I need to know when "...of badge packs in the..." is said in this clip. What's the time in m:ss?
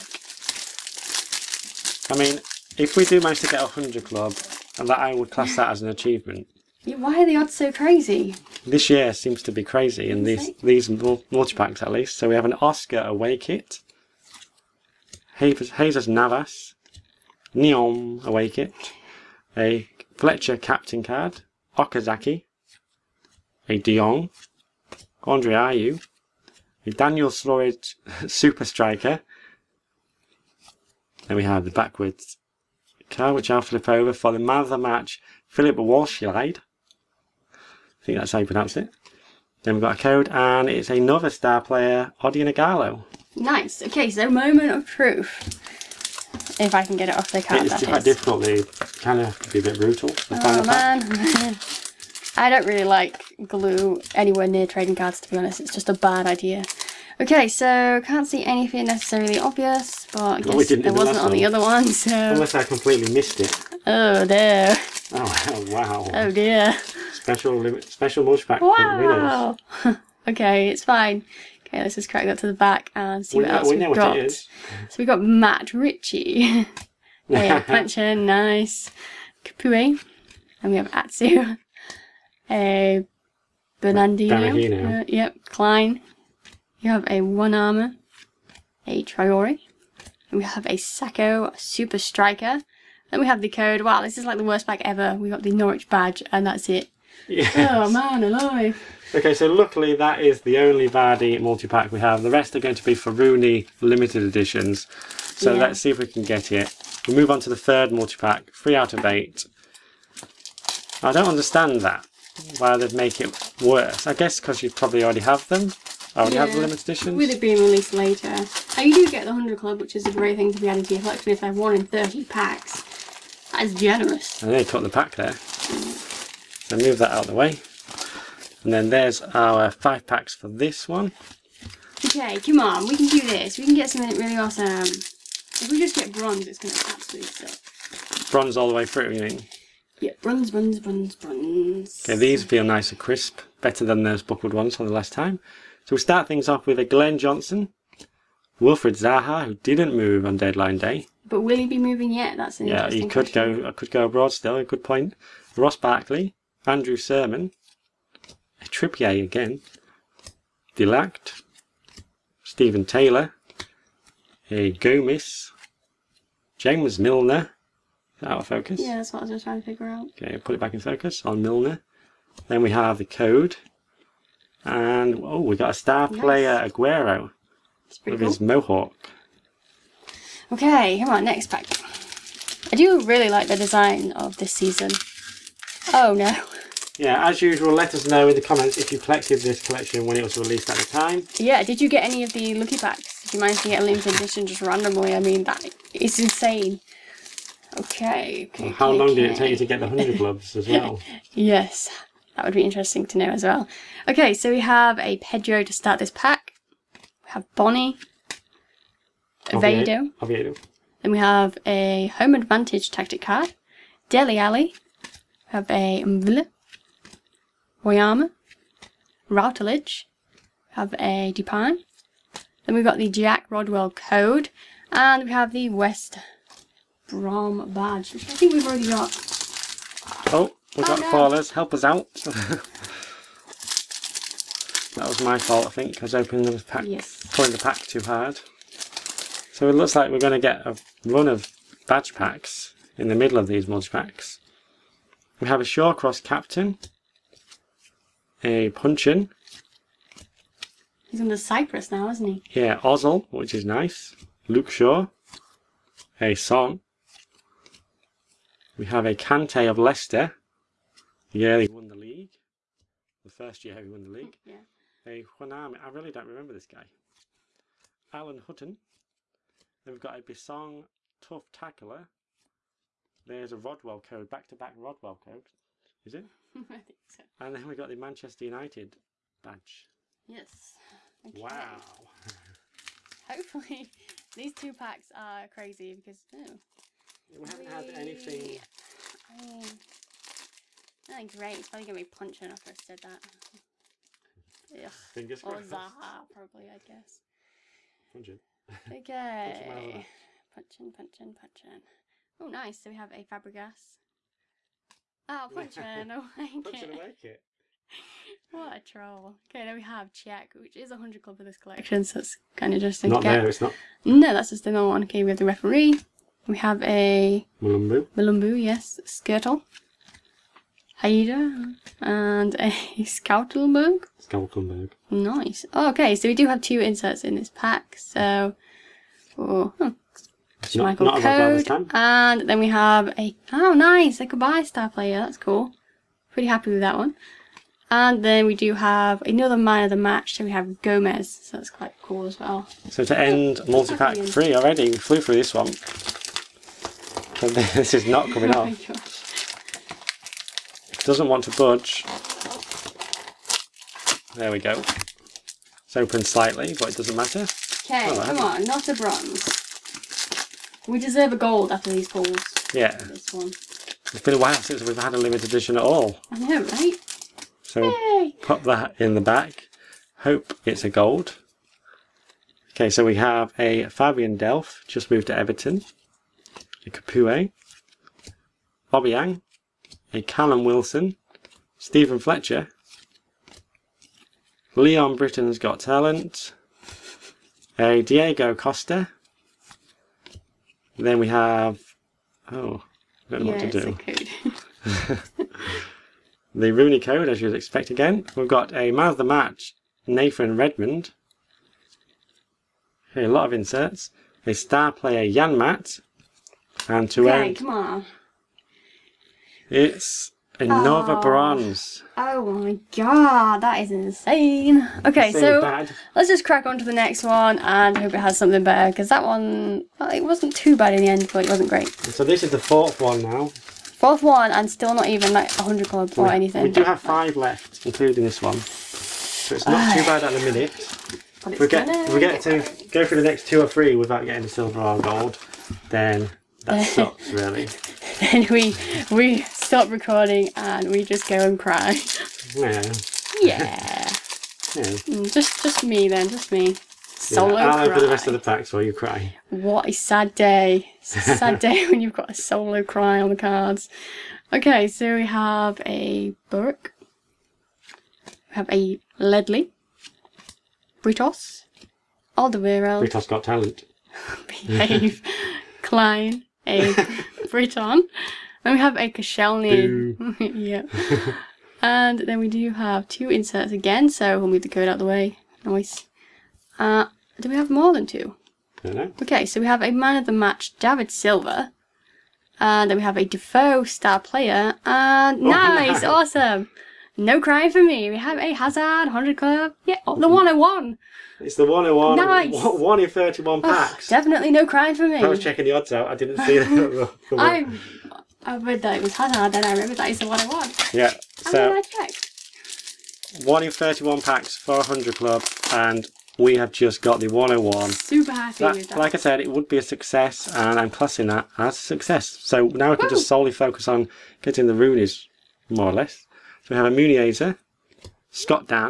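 4:01.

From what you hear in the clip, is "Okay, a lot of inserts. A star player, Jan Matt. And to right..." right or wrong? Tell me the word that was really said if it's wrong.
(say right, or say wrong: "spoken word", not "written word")
right.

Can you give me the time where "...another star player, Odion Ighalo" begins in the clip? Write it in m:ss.
0:40.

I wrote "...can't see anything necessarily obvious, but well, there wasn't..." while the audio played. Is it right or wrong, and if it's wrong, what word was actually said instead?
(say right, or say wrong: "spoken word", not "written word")
right.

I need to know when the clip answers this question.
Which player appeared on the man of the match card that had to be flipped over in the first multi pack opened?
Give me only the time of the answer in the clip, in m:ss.
0:35.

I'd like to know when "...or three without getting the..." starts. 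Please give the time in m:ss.
7:13.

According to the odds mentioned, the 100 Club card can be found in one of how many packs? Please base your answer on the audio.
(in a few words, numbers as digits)
30.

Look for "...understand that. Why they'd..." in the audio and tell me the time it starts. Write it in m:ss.
1:51.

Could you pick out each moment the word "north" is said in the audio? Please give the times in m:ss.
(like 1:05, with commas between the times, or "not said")
not said.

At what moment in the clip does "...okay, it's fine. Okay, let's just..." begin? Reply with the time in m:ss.
1:10.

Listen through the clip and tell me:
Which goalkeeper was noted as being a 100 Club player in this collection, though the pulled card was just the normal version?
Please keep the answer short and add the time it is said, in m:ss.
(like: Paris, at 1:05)
Cech, at 5:10.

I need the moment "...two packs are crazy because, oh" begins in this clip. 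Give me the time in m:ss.
4:44.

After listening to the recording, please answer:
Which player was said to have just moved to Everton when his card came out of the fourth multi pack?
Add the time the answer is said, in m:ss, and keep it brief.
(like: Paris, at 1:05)
Fabian Delph, at 6:13.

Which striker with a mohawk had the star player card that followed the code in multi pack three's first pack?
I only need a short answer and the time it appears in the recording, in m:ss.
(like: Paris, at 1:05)
Aguero, at 2:56.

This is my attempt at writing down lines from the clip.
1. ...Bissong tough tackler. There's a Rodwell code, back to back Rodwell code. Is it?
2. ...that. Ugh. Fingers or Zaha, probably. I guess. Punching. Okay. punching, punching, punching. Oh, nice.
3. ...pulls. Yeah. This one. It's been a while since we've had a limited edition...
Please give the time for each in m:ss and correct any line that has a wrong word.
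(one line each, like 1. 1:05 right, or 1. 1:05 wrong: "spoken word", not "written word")
1. 4:30 right
2. 4:52 right
3. 6:02 right.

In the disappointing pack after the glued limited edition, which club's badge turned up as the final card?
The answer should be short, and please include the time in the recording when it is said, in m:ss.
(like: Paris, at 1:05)
Norwich, at 1:35.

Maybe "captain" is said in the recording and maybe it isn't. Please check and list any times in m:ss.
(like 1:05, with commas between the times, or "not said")
0:20, 4:06.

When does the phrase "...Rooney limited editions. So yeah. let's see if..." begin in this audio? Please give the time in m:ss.
1:43.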